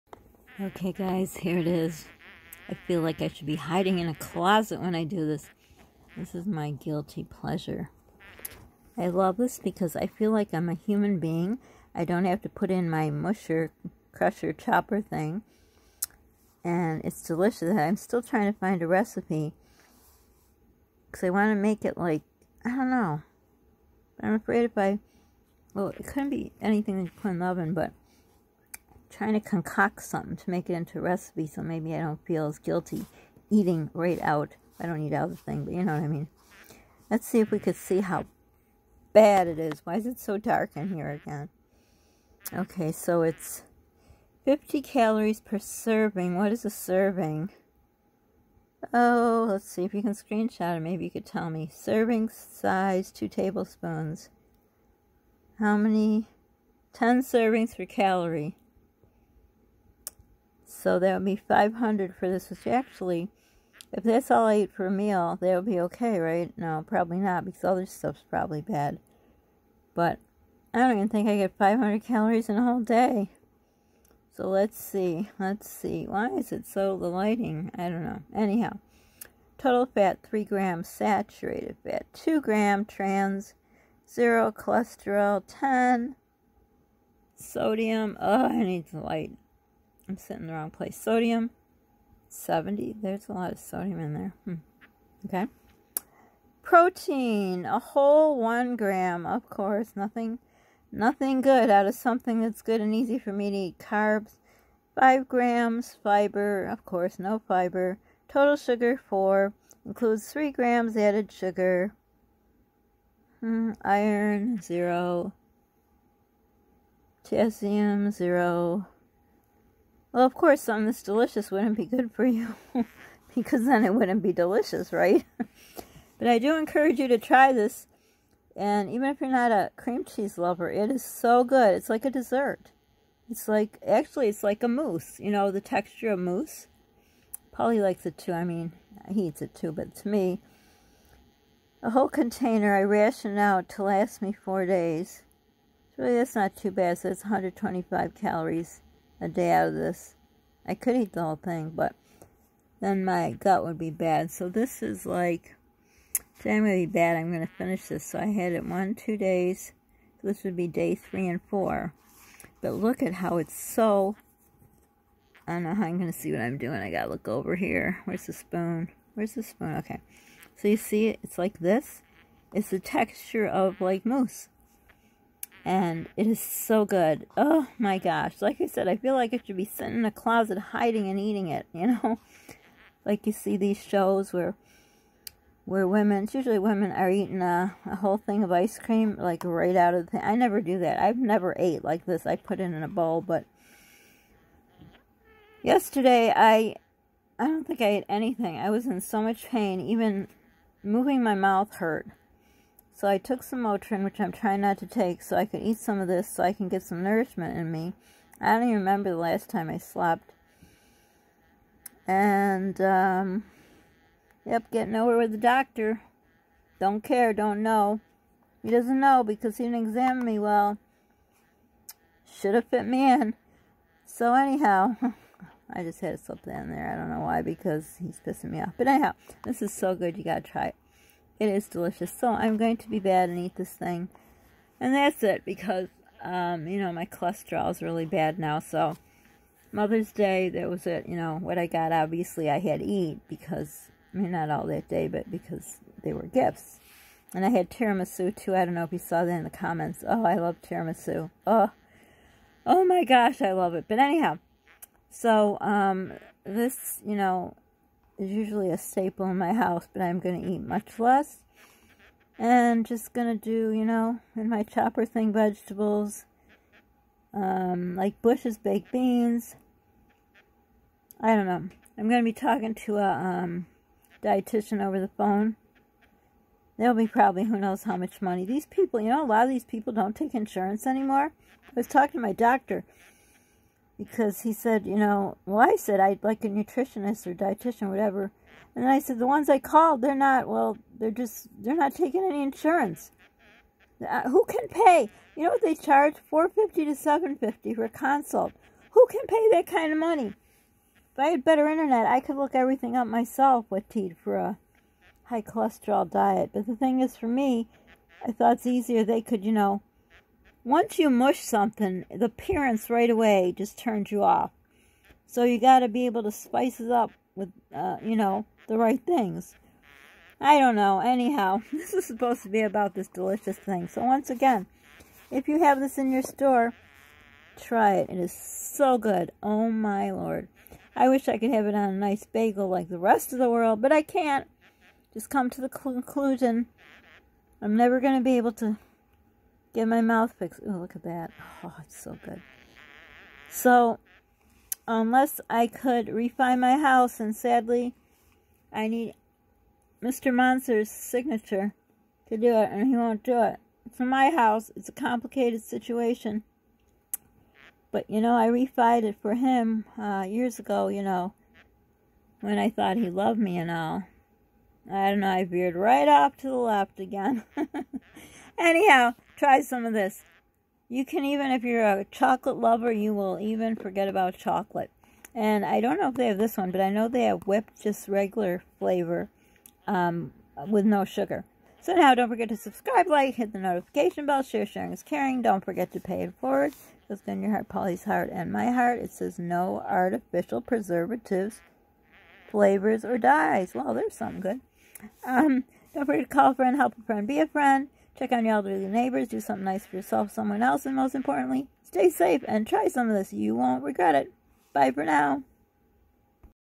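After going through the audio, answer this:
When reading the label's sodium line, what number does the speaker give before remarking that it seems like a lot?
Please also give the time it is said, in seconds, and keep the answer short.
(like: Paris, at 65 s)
70, at 92 s.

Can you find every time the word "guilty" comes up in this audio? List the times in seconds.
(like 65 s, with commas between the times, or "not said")
6 s, 32 s.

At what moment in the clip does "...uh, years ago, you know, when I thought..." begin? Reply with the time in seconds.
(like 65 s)
359 s.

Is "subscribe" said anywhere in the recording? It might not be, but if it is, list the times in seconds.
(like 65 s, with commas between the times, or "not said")
382 s.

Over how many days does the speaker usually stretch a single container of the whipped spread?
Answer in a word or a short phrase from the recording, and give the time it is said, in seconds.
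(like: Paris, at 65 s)
4 days, at 144 s.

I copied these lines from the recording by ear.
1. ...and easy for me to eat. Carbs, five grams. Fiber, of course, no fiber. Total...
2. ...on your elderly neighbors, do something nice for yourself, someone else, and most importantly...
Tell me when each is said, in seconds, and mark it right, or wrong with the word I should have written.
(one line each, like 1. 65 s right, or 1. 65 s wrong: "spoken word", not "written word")
1. 102 s right
2. 398 s right.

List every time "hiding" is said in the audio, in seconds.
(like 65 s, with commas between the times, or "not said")
3 s, 180 s.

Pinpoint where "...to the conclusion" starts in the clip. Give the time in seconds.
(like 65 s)
335 s.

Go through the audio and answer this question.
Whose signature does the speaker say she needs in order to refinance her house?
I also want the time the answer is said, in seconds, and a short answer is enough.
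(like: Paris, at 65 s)
Mr. Monster, at 350 s.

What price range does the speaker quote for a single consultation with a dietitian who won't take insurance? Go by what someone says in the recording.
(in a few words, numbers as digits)
450 to 750.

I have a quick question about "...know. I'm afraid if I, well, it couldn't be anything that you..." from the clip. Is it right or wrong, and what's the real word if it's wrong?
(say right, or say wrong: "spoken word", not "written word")
right.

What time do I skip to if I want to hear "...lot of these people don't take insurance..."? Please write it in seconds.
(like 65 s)
279 s.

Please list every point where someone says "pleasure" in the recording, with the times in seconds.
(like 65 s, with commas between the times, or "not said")
7 s.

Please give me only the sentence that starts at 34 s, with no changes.
I don't eat out the thing, but you know what I mean.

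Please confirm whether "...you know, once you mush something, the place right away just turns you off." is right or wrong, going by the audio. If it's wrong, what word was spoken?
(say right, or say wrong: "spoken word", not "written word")
wrong: "appearance", not "place".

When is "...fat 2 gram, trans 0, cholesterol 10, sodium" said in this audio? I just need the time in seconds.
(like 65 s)
81 s.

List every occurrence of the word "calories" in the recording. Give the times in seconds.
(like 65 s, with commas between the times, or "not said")
44 s, 57 s, 72 s, 148 s.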